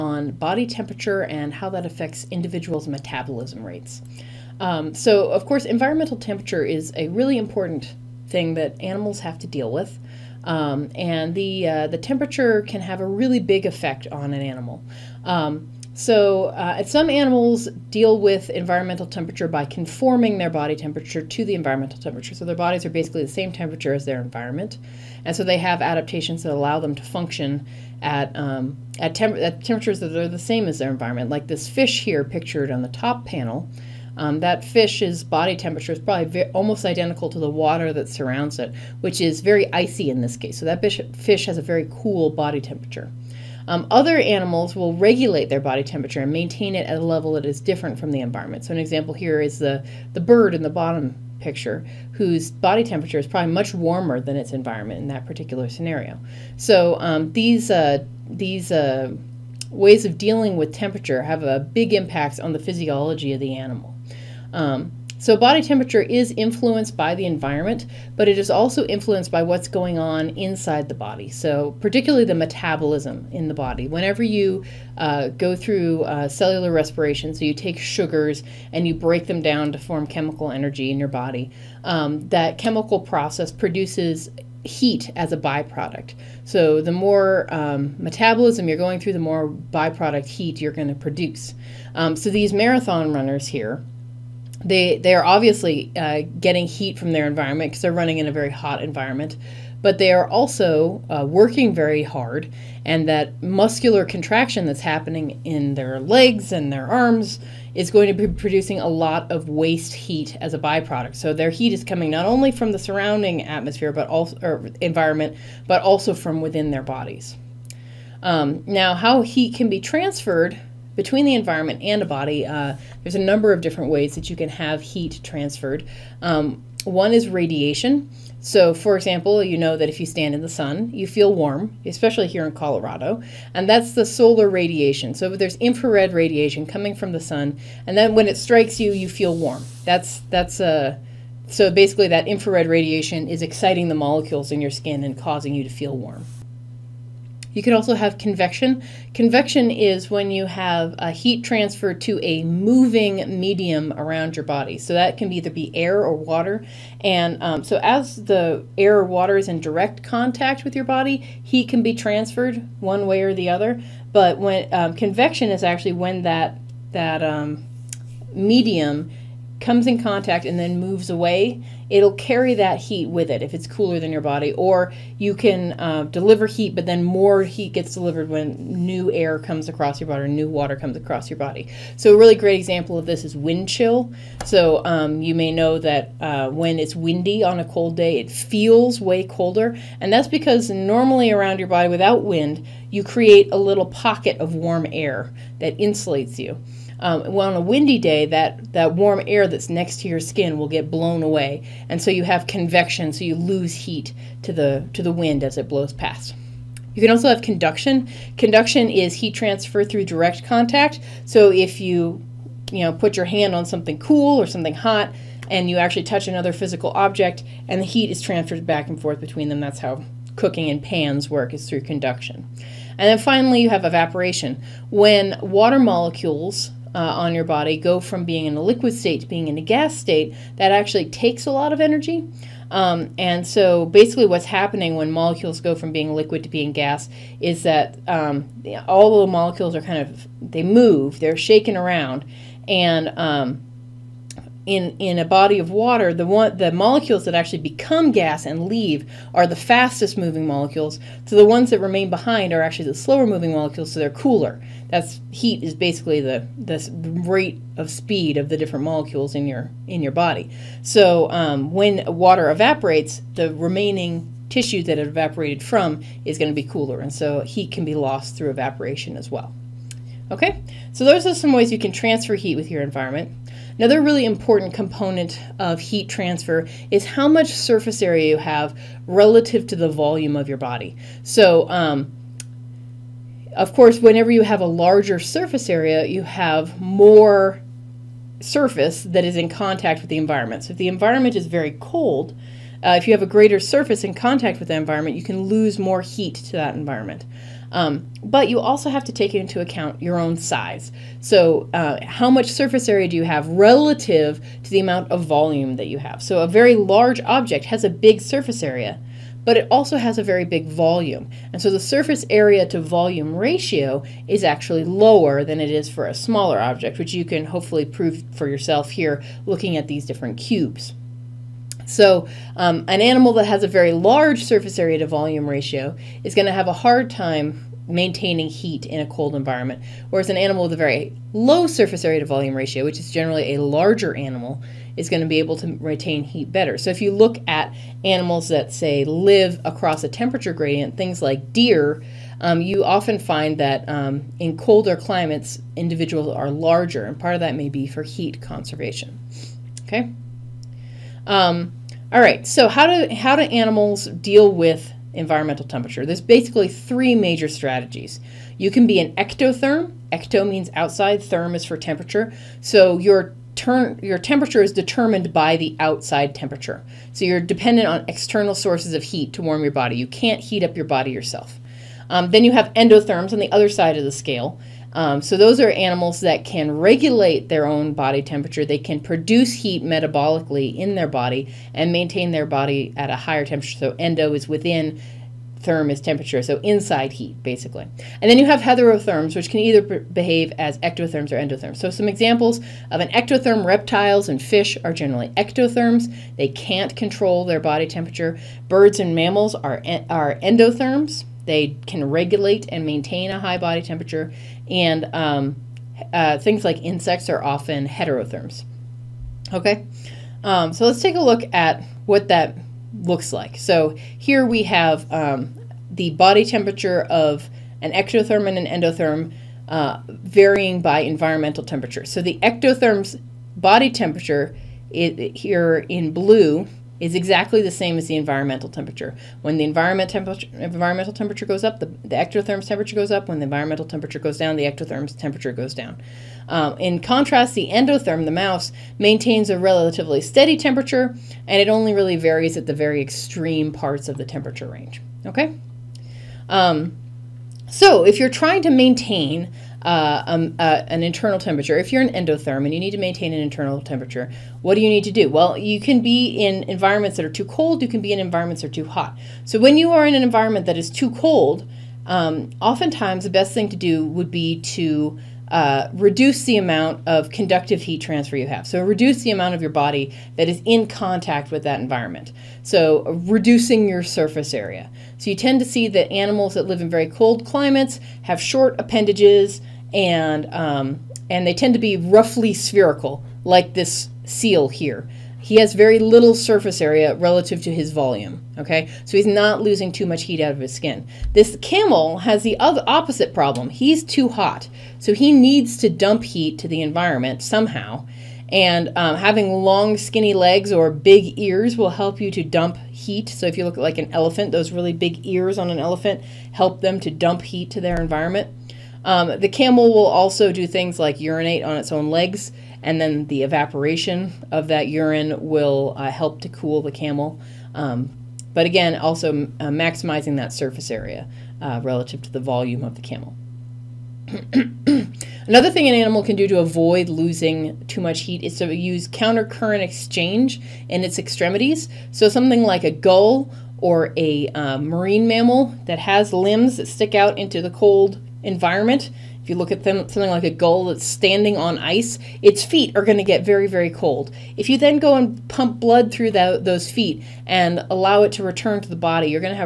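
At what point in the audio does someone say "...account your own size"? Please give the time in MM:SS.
04:59.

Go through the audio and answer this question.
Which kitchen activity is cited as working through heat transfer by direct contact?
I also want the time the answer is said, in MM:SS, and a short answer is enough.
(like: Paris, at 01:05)
Cooking in pans, at 03:40.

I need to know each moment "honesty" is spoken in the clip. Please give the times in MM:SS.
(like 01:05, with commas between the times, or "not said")
not said.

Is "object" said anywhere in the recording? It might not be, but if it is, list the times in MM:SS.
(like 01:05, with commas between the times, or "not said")
03:36, 05:07, 05:16.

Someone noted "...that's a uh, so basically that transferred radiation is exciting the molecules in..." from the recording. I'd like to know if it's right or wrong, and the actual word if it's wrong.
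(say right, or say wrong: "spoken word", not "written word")
wrong: "infrared", not "transferred".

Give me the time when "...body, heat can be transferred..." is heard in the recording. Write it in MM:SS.
02:40.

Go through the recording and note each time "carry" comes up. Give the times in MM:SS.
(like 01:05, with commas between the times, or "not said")
02:52.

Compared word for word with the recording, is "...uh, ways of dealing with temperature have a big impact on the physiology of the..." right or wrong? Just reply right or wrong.
right.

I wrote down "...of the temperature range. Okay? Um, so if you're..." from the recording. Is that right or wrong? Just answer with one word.
right.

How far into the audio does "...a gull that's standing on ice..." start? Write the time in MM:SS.
09:00.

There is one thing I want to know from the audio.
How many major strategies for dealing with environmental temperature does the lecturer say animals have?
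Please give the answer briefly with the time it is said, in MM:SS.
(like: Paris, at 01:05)
3, at 05:56.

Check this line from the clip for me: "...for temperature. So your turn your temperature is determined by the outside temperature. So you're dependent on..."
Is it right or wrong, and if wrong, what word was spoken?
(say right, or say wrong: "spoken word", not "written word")
right.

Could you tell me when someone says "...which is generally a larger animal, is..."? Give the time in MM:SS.
05:32.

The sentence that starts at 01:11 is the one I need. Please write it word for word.
So, particularly the metabolism in the body.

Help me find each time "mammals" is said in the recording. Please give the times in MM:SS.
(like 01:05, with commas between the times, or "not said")
06:39, 08:55.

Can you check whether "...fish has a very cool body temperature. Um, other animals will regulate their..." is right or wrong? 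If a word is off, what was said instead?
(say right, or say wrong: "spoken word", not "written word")
right.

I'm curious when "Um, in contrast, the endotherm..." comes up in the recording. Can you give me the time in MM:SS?
07:16.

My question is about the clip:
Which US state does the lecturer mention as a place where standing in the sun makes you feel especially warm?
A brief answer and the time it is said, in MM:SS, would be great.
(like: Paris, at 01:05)
Colorado, at 02:12.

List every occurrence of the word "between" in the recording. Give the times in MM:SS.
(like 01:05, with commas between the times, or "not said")
02:00, 03:39.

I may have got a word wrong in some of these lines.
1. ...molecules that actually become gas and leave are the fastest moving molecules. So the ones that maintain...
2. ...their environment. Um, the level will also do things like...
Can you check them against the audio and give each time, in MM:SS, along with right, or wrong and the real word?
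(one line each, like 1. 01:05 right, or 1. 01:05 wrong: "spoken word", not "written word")
1. 04:06 wrong: "remain", not "maintain"
2. 08:27 wrong: "camel", not "level".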